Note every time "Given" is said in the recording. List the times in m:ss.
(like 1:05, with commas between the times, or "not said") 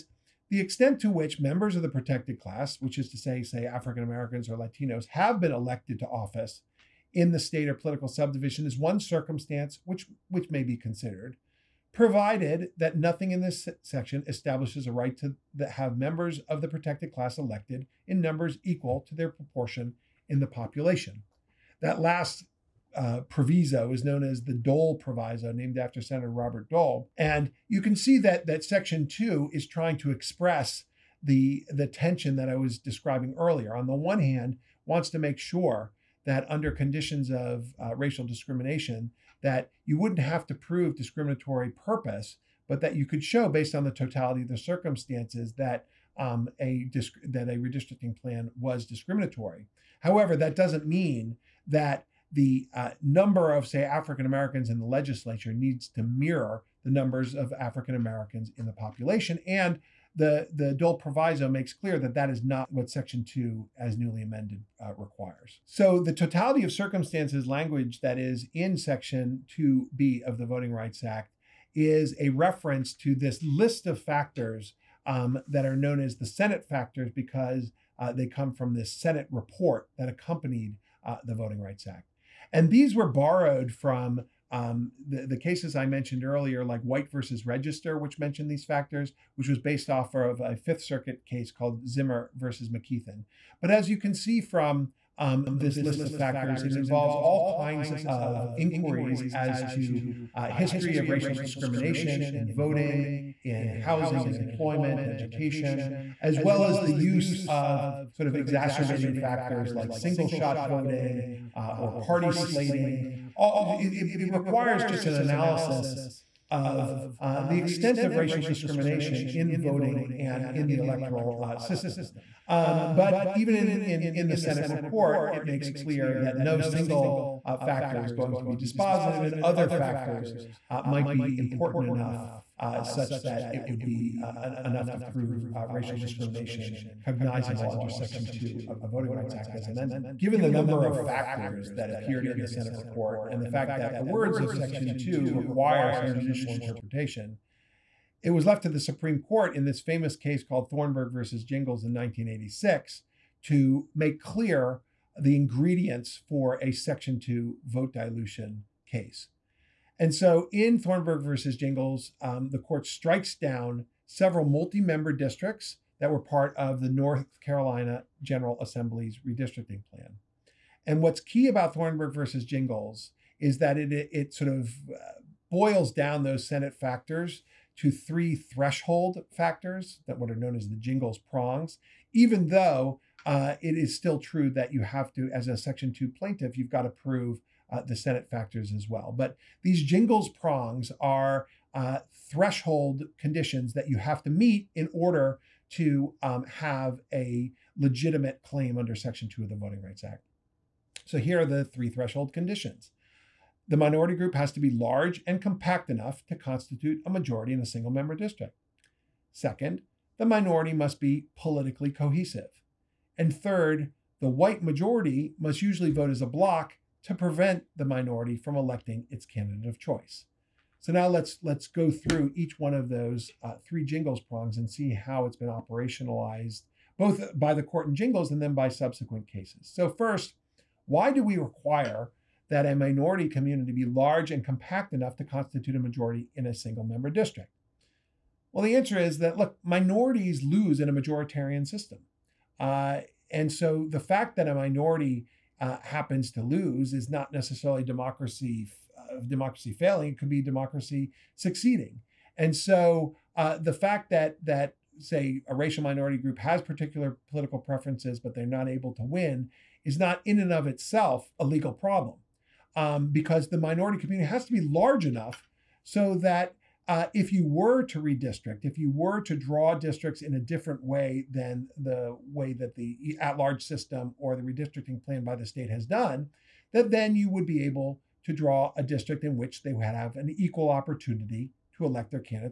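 2:20.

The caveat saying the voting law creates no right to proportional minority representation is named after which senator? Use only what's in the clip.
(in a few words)
Robert Dole.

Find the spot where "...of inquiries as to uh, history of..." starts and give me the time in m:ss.
1:38.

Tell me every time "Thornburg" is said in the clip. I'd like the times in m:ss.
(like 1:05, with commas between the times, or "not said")
2:30, 2:40, 2:51.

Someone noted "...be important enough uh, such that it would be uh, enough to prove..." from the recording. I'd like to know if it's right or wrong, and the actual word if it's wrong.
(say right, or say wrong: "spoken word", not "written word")
right.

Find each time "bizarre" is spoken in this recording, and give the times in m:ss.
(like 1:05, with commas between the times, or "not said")
not said.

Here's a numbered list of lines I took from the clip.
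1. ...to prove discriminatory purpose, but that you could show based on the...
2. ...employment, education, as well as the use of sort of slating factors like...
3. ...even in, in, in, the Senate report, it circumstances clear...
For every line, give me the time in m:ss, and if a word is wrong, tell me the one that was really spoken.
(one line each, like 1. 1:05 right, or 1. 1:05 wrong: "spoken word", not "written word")
1. 0:40 right
2. 1:44 wrong: "exacerbating", not "slating"
3. 2:03 wrong: "makes", not "circumstances".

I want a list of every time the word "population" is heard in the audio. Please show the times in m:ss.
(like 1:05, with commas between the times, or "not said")
0:20, 0:58.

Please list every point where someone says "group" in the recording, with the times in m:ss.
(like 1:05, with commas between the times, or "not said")
3:24, 4:16.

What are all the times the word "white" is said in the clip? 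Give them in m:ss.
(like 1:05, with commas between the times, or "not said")
1:26, 3:34.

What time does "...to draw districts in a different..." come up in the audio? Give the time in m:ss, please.
4:29.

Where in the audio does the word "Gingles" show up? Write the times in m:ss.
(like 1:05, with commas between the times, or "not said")
2:31, 2:41, 2:52, 3:00, 3:09, 3:43, 3:47.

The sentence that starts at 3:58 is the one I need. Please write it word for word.
Well, the answer is that look, minorities lose in a majoritarian system.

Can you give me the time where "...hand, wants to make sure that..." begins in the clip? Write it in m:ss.
0:34.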